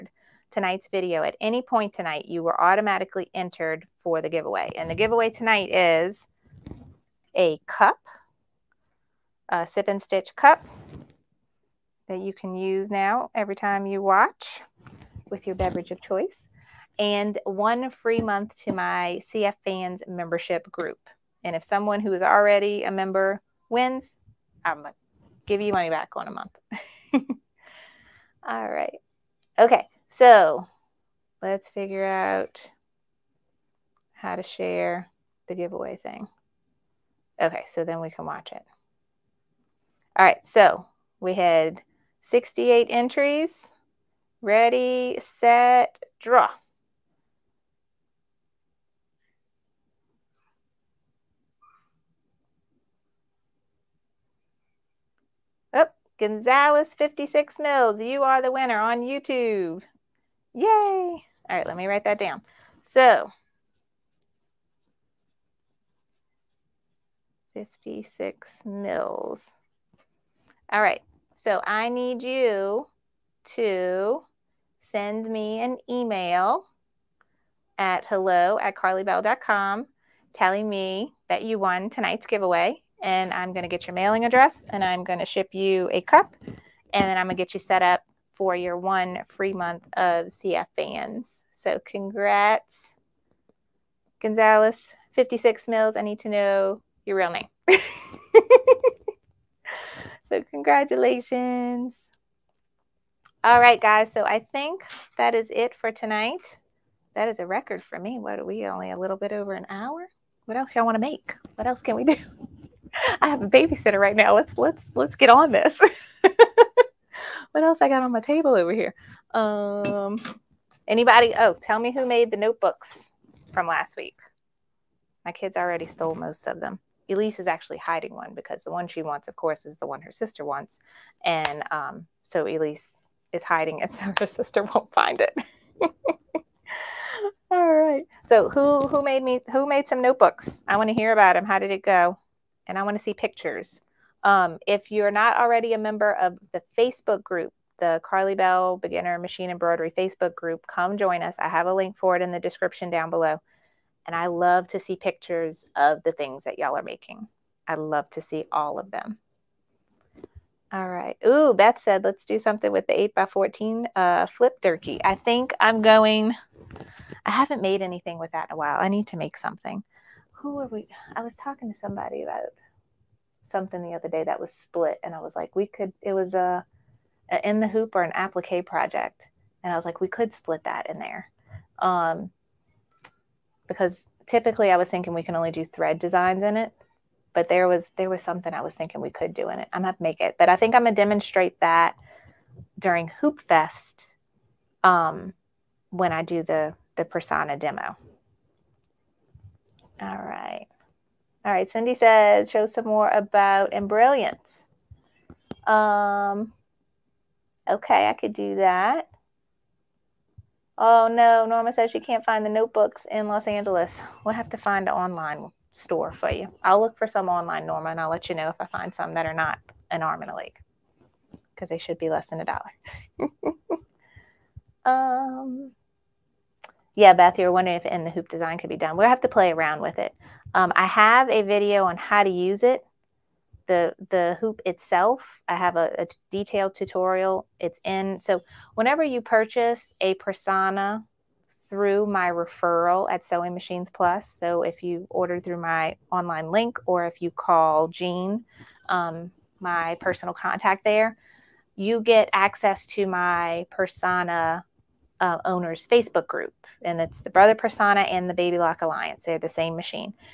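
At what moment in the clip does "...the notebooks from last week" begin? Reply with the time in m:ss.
2:02.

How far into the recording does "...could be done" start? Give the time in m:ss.
3:48.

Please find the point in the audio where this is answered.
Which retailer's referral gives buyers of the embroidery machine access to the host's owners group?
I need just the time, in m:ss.
4:03.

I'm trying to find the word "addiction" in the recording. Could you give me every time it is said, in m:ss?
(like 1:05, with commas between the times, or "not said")
not said.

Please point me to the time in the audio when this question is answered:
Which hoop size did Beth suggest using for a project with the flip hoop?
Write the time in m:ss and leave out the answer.
2:42.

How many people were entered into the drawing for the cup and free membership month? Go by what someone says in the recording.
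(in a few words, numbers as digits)
68.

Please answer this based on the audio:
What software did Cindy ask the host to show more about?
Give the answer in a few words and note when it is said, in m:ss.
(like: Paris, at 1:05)
Embrilliance, at 3:23.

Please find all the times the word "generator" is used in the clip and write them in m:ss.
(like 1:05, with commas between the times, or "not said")
not said.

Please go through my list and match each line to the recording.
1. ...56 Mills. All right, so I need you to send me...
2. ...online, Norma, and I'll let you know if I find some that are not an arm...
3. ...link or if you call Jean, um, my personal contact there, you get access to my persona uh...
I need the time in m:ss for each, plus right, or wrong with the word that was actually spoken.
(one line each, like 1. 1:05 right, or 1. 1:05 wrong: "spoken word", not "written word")
1. 1:07 right
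2. 3:37 right
3. 4:06 right.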